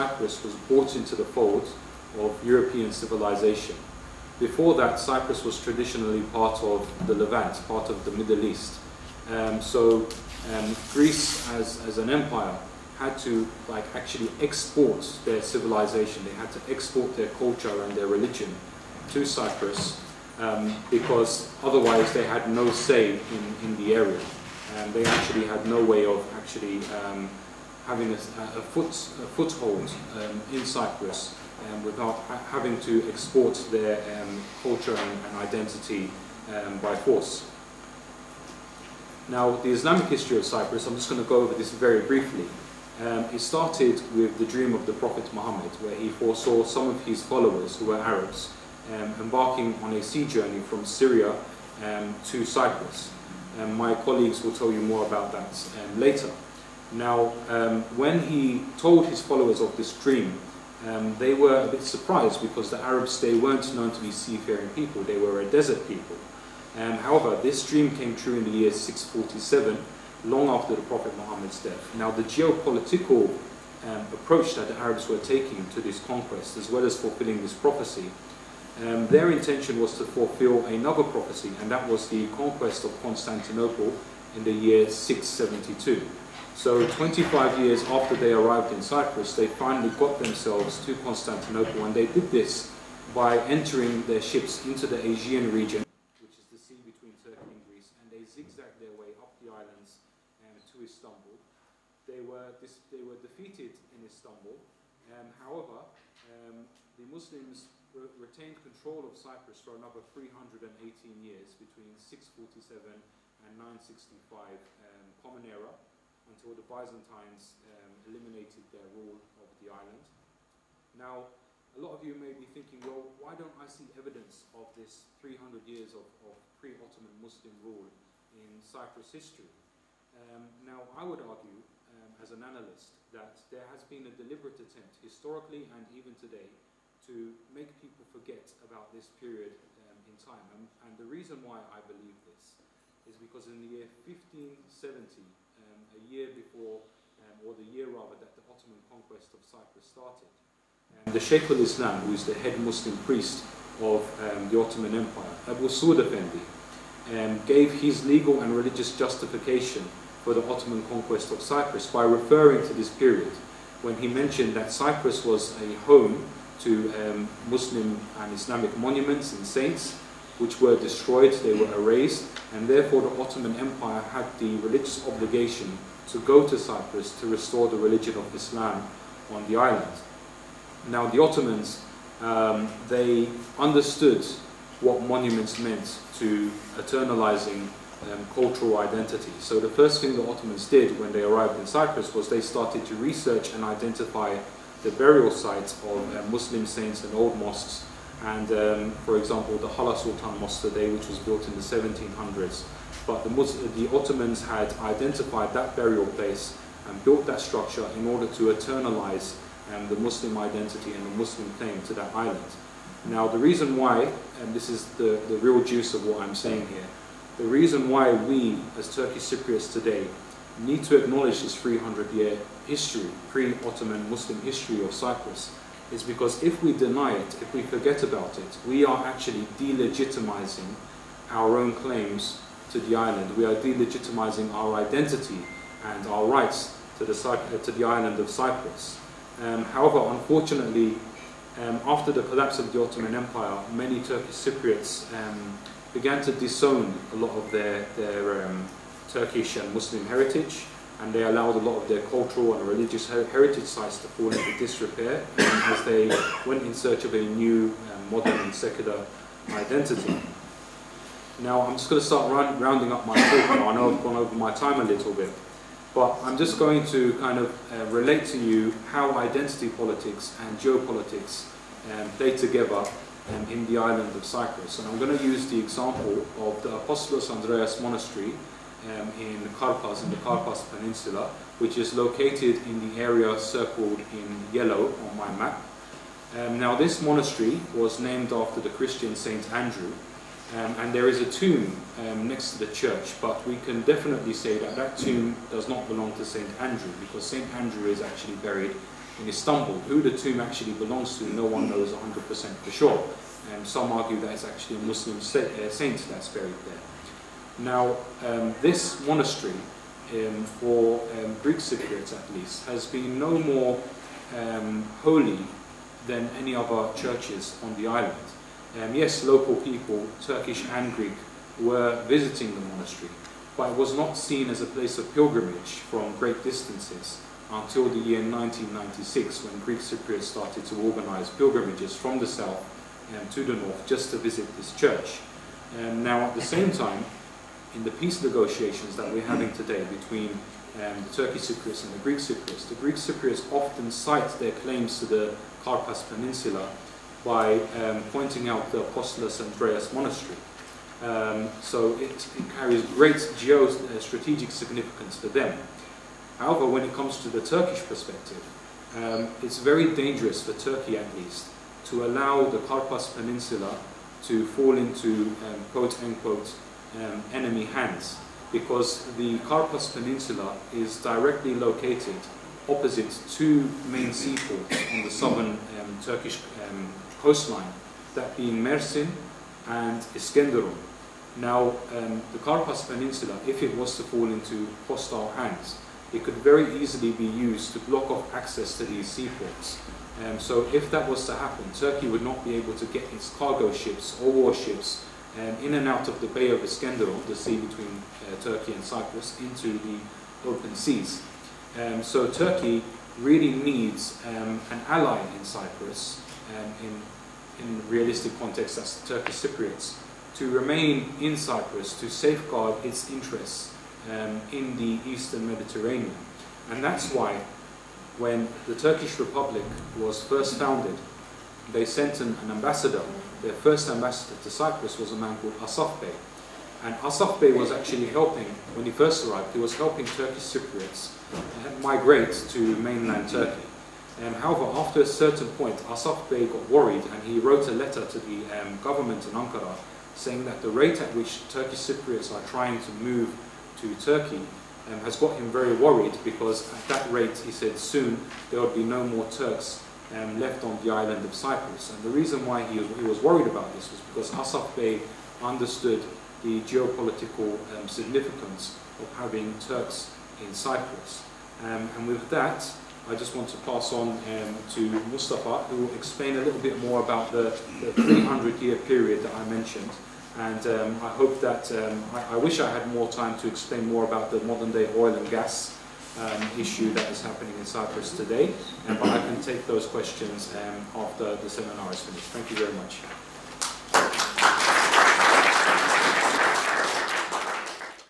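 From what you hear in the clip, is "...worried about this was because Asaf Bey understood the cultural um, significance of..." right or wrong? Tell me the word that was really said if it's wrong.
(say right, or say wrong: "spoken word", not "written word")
wrong: "geopolitical", not "cultural".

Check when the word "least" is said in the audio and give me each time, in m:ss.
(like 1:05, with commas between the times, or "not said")
5:12, 6:01.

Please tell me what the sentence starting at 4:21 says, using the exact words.
Now I'm just going to start round, rounding up my talk now.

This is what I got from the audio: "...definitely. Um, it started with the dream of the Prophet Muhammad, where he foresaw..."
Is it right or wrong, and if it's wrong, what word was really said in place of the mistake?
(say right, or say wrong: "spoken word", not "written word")
wrong: "briefly", not "definitely".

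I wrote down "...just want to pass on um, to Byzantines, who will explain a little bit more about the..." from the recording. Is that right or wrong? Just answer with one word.
wrong.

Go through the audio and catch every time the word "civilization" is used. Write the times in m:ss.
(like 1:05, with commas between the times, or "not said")
0:02, 0:15.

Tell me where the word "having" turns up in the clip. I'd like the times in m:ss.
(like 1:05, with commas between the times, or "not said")
0:27, 0:32, 5:39, 7:39.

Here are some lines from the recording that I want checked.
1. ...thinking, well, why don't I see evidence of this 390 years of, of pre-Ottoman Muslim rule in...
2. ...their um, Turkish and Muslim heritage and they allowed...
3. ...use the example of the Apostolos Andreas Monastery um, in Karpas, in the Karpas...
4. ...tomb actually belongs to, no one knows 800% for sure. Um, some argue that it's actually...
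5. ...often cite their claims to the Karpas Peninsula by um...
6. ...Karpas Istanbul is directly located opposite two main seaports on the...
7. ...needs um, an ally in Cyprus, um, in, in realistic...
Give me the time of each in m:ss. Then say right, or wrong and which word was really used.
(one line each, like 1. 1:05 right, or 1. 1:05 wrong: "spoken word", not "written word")
1. 2:02 wrong: "300", not "390"
2. 4:07 right
3. 4:35 right
4. 5:00 wrong: "100", not "800"
5. 5:43 right
6. 6:09 wrong: "Peninsula", not "Istanbul"
7. 6:43 right.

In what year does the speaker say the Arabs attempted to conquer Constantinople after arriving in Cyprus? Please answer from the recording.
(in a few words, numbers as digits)
672.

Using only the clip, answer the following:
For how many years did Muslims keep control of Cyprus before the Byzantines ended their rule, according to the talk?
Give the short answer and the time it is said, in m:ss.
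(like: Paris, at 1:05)
318, at 1:50.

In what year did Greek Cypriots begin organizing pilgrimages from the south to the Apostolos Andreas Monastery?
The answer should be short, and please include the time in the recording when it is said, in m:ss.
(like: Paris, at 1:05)
1996, at 5:28.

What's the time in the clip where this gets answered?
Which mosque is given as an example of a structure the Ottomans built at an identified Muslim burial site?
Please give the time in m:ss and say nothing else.
3:19.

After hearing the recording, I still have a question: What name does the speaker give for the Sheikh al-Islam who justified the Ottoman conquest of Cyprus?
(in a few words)
Abu Sud Effendi.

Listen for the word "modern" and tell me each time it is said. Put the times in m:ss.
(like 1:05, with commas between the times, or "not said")
4:18, 7:54.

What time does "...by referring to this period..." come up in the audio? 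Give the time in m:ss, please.
2:41.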